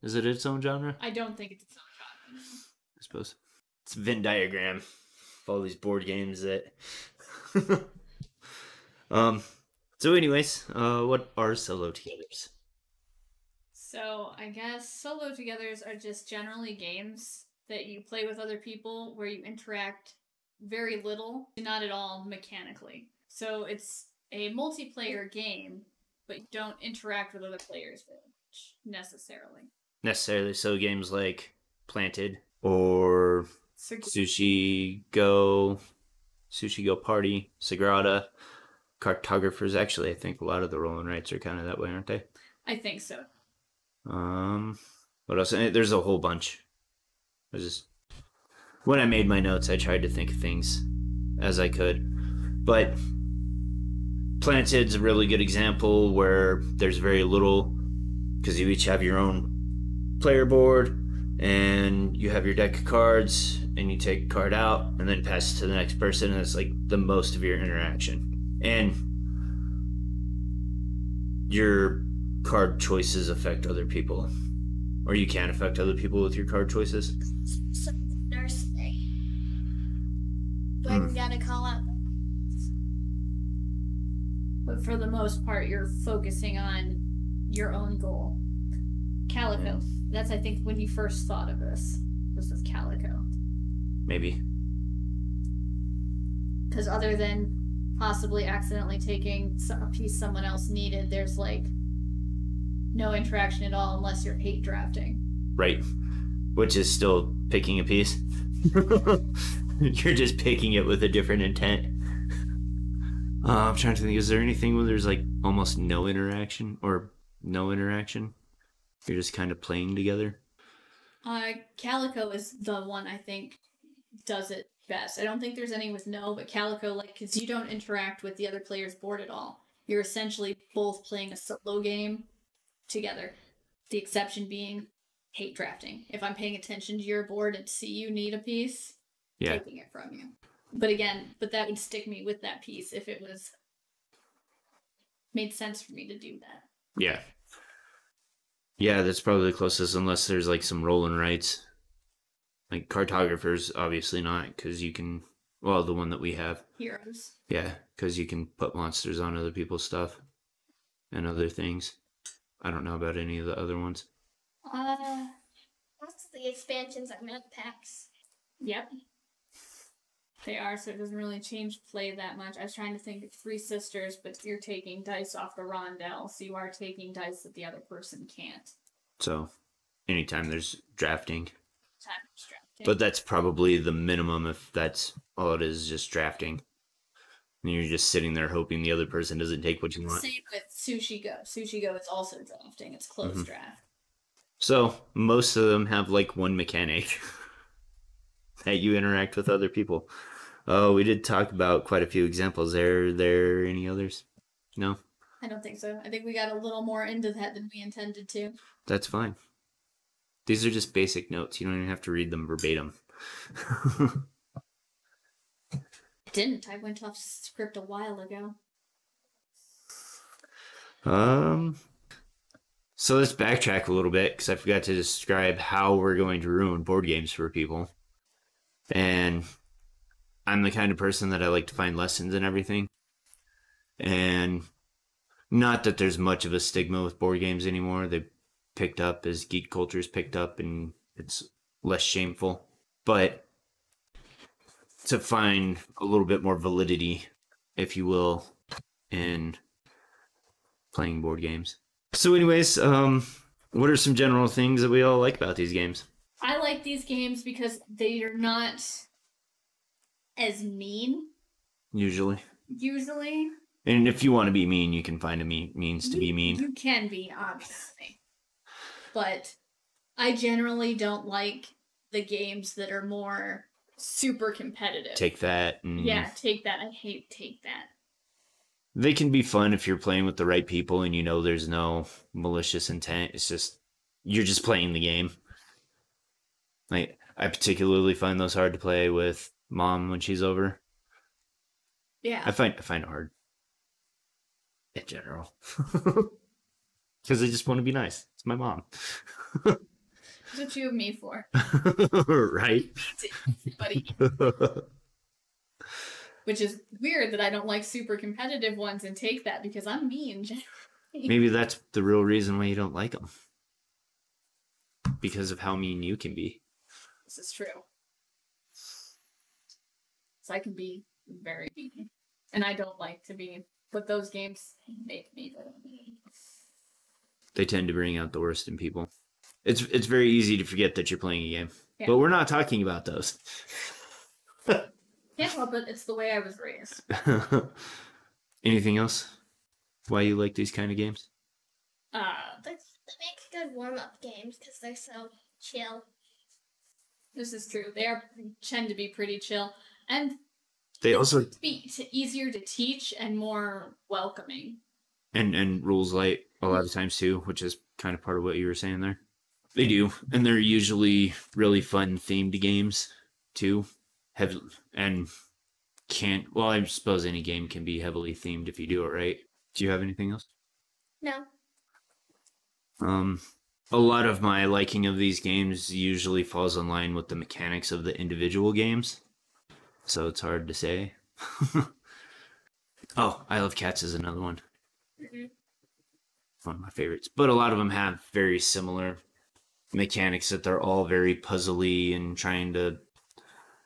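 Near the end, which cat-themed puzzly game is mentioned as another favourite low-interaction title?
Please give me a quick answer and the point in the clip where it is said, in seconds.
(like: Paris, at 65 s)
Isle of Cats, at 383 s.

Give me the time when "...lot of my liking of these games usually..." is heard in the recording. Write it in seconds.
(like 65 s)
373 s.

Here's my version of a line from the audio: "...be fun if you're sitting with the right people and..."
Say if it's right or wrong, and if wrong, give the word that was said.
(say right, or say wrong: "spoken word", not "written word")
wrong: "playing", not "sitting".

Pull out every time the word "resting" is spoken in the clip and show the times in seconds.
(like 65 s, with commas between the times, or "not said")
not said.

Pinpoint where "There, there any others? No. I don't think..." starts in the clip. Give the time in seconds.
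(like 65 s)
202 s.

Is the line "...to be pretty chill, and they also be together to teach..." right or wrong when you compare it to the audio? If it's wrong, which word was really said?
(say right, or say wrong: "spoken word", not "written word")
wrong: "easier", not "together".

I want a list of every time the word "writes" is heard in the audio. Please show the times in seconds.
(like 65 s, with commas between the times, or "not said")
41 s, 151 s.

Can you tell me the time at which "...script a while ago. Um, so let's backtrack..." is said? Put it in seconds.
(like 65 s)
217 s.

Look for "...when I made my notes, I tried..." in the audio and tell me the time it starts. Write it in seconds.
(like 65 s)
48 s.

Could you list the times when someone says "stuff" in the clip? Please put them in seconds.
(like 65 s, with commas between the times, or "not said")
159 s.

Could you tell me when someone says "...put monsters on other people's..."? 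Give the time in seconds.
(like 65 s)
158 s.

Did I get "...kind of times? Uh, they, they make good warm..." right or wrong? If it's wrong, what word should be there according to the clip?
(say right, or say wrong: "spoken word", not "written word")
wrong: "games", not "times".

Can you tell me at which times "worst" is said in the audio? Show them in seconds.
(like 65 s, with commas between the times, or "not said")
328 s.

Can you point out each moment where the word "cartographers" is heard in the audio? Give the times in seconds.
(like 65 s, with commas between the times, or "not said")
39 s, 152 s.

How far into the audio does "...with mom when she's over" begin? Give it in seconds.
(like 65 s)
289 s.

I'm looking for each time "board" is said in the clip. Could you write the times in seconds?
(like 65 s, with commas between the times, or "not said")
5 s, 60 s, 128 s, 137 s, 226 s, 237 s, 251 s.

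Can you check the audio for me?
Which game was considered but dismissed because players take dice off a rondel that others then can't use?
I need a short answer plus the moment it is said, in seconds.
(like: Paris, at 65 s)
Three Sisters, at 173 s.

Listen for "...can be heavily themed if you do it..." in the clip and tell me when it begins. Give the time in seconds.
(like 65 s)
367 s.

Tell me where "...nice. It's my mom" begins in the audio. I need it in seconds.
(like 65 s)
297 s.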